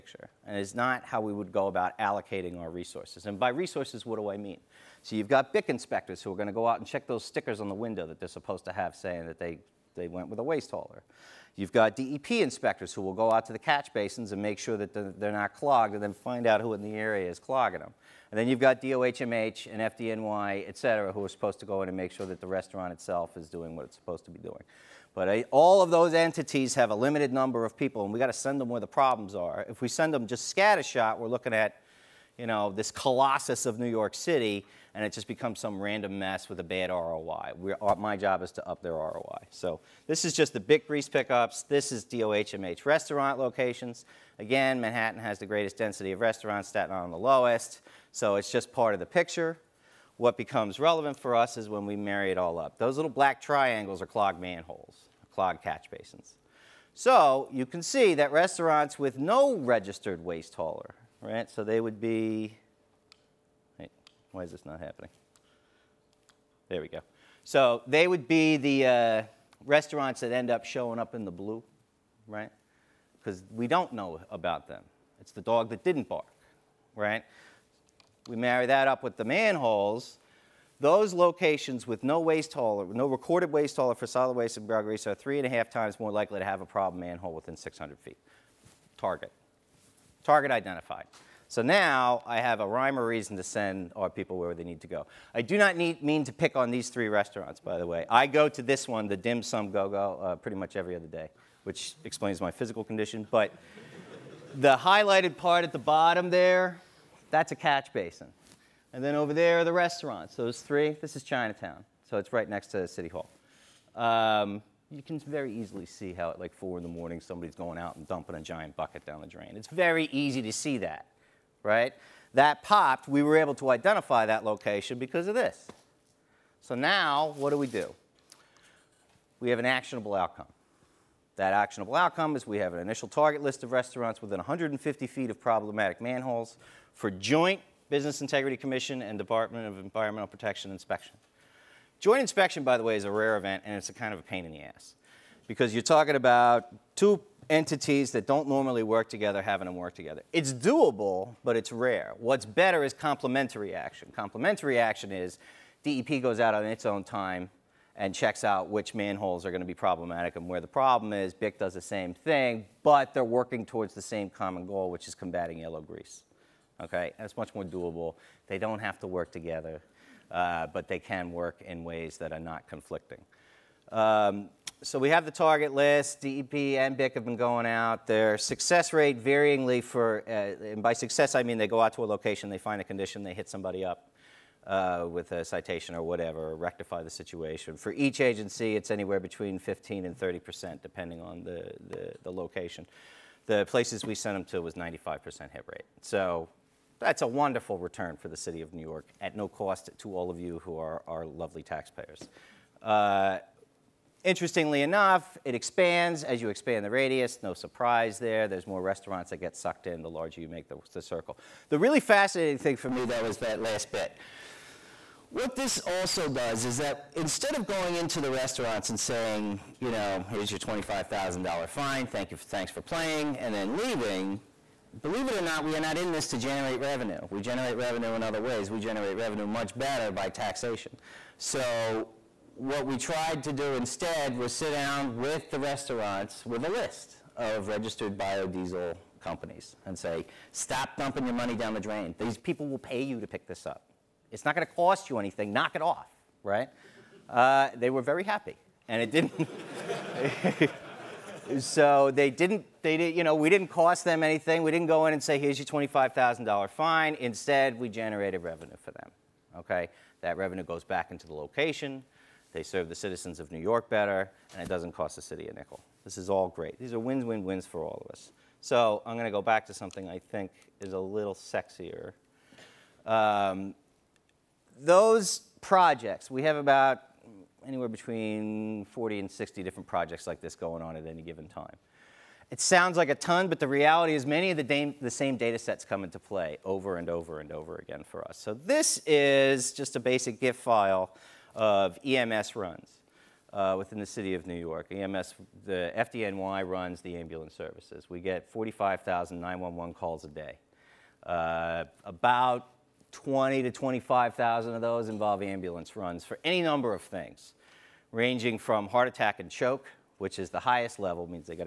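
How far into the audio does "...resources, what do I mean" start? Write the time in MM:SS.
00:03.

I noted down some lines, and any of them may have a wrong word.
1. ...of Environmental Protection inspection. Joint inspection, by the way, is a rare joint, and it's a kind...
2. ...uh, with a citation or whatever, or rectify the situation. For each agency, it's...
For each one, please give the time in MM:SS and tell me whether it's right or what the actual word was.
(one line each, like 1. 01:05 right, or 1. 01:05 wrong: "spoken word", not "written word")
1. 02:19 wrong: "event", not "joint"
2. 03:04 right.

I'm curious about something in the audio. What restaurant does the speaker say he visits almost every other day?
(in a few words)
Dim Sum Go Go.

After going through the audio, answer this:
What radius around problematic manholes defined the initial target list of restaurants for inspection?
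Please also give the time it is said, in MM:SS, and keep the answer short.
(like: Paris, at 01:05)
150 feet, at 02:14.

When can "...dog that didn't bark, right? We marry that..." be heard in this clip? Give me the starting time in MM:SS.
01:15.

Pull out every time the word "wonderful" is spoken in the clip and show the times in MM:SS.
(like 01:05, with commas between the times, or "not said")
03:17.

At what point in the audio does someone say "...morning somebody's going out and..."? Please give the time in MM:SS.
01:56.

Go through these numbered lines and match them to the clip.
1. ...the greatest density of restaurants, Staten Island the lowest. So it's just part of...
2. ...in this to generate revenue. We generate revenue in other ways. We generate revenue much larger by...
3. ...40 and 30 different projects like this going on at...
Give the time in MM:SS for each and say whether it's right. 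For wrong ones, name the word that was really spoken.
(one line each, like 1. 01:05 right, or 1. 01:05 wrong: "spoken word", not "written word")
1. 00:45 right
2. 03:45 wrong: "better", not "larger"
3. 04:38 wrong: "60", not "30".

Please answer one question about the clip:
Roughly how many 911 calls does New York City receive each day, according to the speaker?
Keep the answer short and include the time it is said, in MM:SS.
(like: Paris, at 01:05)
45,000, at 04:58.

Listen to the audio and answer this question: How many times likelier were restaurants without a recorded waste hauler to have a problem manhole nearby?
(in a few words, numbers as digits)
3.5.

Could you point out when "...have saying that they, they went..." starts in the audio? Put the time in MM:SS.
00:08.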